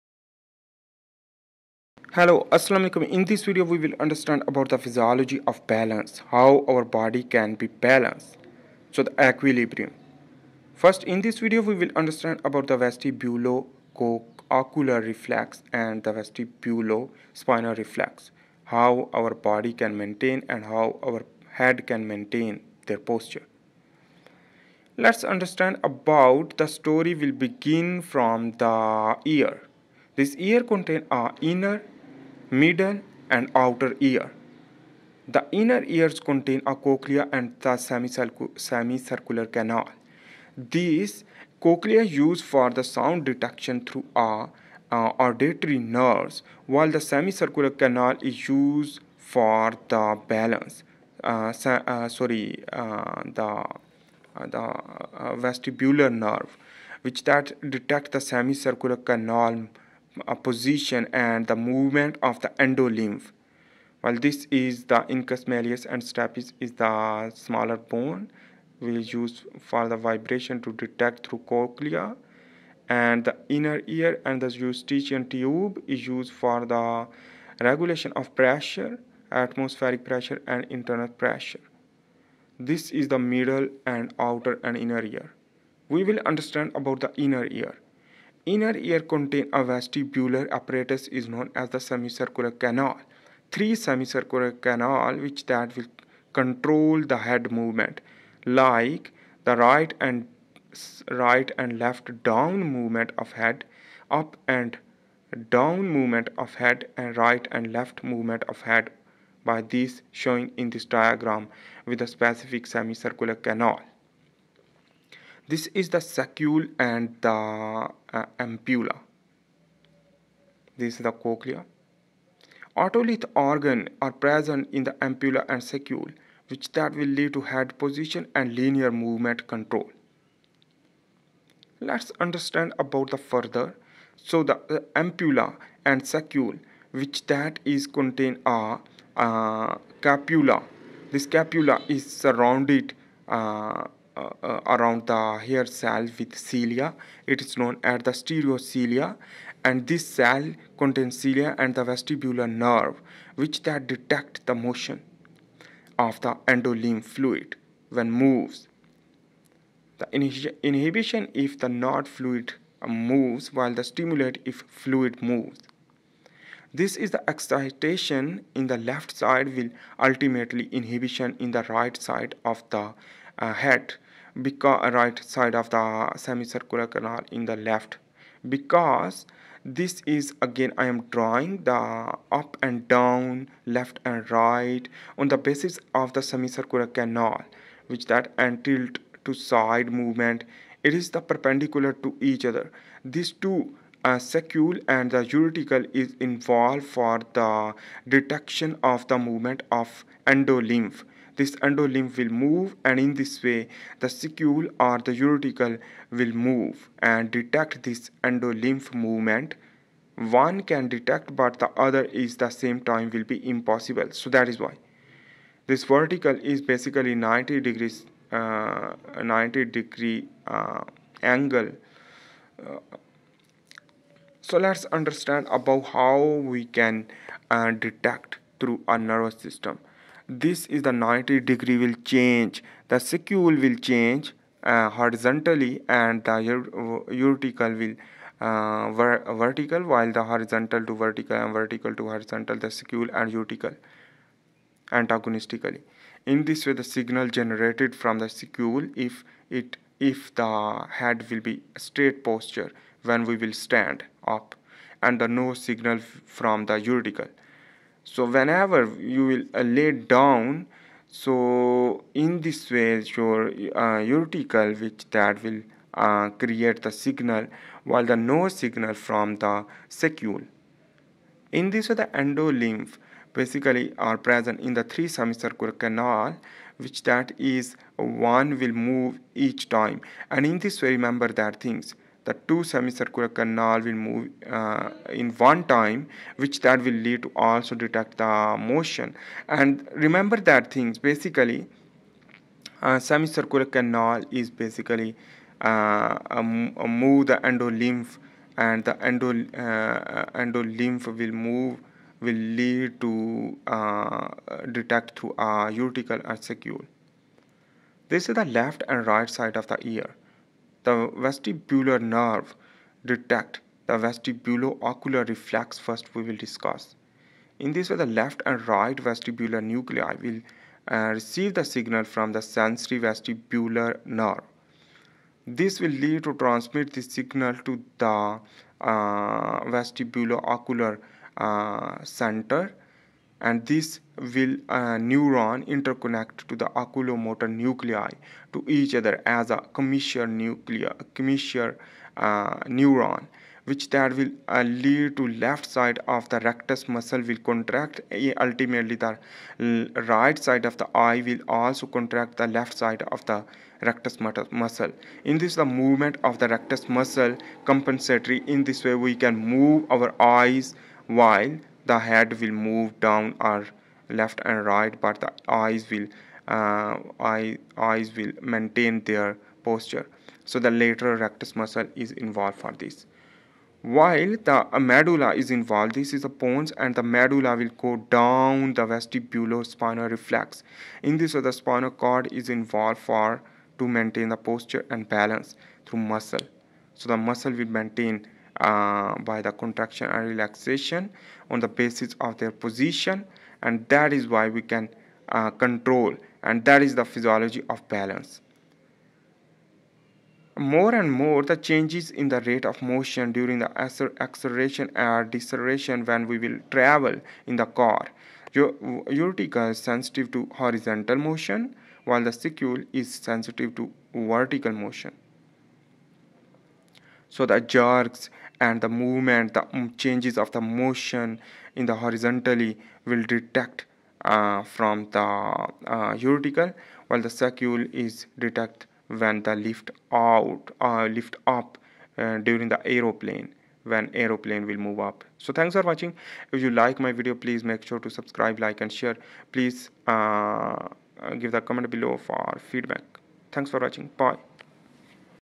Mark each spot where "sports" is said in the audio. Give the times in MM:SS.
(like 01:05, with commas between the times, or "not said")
not said.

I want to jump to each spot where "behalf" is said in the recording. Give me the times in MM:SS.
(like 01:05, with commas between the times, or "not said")
not said.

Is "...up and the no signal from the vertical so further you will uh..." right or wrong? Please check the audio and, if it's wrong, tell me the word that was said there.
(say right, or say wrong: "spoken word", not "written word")
wrong: "whenever", not "further".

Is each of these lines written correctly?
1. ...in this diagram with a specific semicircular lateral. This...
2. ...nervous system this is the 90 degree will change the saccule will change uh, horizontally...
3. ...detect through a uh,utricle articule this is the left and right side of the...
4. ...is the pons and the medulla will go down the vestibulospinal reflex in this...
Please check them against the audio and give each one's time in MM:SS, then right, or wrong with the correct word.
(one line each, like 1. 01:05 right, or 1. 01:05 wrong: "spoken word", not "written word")
1. 01:50 wrong: "canal", not "lateral"
2. 03:48 right
3. 05:04 right
4. 06:16 right.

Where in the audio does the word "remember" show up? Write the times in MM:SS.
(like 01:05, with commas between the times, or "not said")
04:40, 04:49.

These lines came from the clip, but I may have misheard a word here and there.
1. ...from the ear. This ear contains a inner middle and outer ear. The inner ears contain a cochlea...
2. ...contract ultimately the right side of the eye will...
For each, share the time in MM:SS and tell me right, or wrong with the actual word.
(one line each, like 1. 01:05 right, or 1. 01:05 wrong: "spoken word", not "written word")
1. 00:28 right
2. 05:47 right.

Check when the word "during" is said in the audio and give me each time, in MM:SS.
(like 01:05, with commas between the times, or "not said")
06:43, 07:12.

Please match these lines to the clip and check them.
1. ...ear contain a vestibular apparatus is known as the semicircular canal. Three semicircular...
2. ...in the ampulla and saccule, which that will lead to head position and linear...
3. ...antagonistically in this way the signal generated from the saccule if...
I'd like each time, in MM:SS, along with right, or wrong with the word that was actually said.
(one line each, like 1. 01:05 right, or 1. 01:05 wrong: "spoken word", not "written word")
1. 01:28 right
2. 02:04 right
3. 04:04 right.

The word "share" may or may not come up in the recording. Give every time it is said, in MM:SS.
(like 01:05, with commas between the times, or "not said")
07:18.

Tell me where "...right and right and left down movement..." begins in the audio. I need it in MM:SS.
01:39.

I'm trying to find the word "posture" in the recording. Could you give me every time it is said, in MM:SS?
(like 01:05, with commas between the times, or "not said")
00:22, 04:12, 06:09, 06:24.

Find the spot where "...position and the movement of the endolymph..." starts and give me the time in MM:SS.
01:00.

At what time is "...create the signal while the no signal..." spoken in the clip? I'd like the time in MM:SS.
04:26.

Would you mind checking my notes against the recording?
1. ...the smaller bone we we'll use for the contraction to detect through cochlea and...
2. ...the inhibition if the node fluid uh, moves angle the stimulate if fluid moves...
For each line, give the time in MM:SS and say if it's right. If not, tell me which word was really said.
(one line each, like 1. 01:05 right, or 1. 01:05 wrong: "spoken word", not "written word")
1. 01:06 wrong: "vibration", not "contraction"
2. 02:39 wrong: "while", not "angle".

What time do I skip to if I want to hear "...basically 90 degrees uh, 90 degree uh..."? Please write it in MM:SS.
03:36.